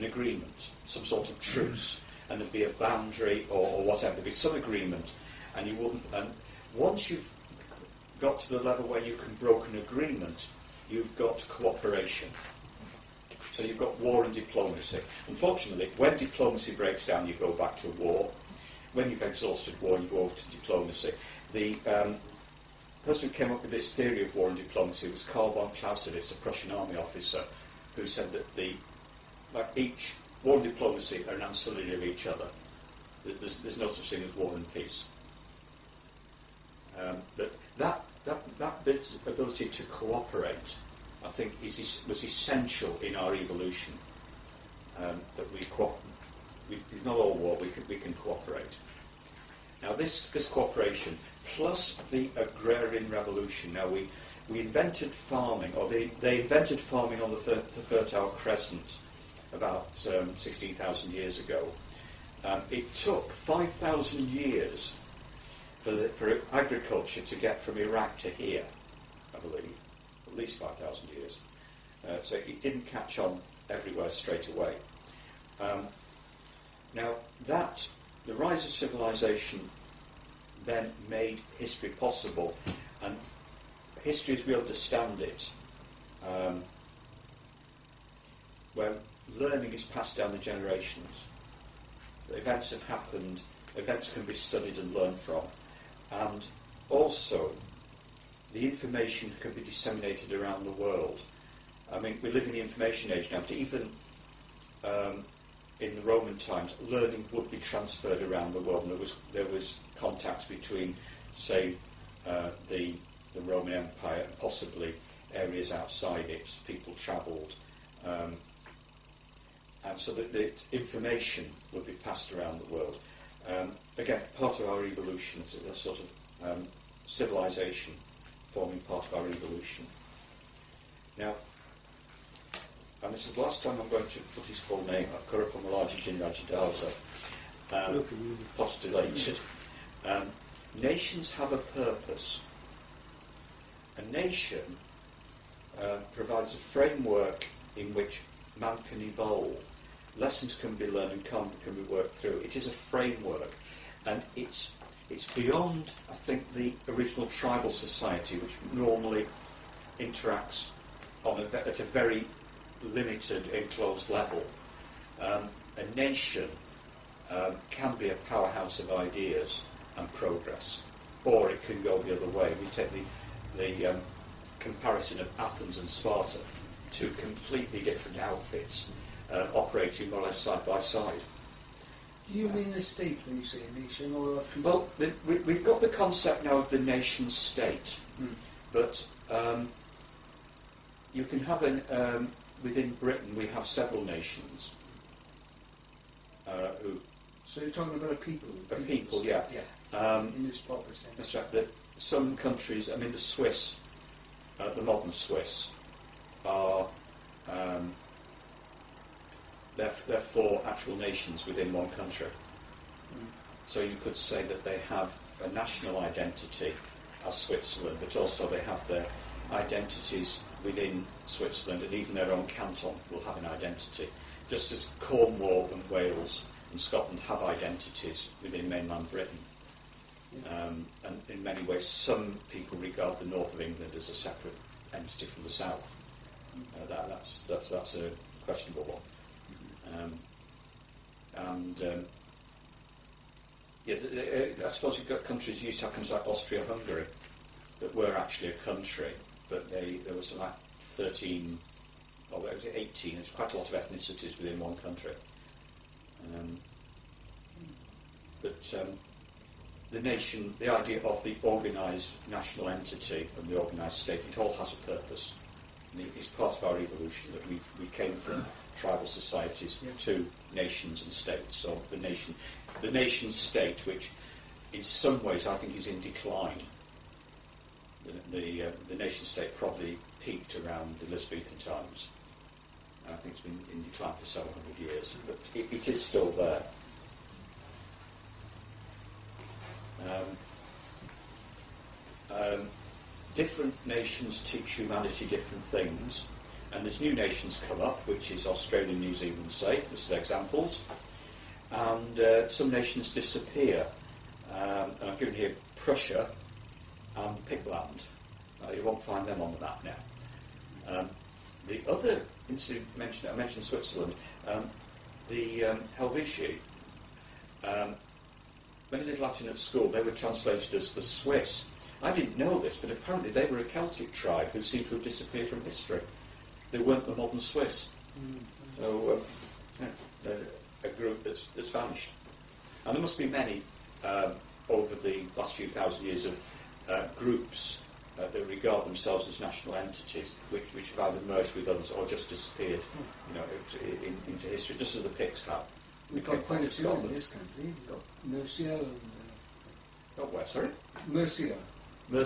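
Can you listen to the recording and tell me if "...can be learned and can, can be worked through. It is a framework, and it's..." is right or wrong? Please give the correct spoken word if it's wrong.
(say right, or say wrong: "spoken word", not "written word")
right.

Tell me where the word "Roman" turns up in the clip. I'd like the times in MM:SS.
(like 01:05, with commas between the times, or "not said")
01:46, 01:53.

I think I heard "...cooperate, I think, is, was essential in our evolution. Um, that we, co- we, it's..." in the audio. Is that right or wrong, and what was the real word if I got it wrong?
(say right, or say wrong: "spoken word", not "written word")
right.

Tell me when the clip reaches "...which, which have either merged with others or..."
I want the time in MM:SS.
05:40.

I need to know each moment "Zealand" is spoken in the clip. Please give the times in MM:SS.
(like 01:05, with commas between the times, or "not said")
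04:59.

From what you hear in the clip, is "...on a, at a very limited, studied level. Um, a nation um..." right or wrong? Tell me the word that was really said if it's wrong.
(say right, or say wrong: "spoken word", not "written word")
wrong: "enclosed", not "studied".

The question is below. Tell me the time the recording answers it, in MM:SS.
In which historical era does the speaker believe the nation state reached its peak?
04:41.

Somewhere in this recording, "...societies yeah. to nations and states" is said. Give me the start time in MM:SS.
04:29.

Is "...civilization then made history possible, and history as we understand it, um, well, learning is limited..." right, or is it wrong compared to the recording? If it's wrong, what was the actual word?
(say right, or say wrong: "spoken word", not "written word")
wrong: "passed", not "limited".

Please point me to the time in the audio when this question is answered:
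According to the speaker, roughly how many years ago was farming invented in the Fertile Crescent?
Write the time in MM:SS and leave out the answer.
01:00.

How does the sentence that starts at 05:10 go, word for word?
Um, the other incident mentioned, I mentioned Switzerland, um, the um, Helvetii.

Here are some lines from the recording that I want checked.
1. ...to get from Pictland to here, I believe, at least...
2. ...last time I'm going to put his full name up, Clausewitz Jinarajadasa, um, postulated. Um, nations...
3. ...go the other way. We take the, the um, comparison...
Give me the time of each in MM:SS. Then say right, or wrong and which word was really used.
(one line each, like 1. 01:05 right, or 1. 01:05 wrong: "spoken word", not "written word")
1. 01:07 wrong: "Iraq", not "Pictland"
2. 02:13 wrong: "Curuppumullage", not "Clausewitz"
3. 02:51 right.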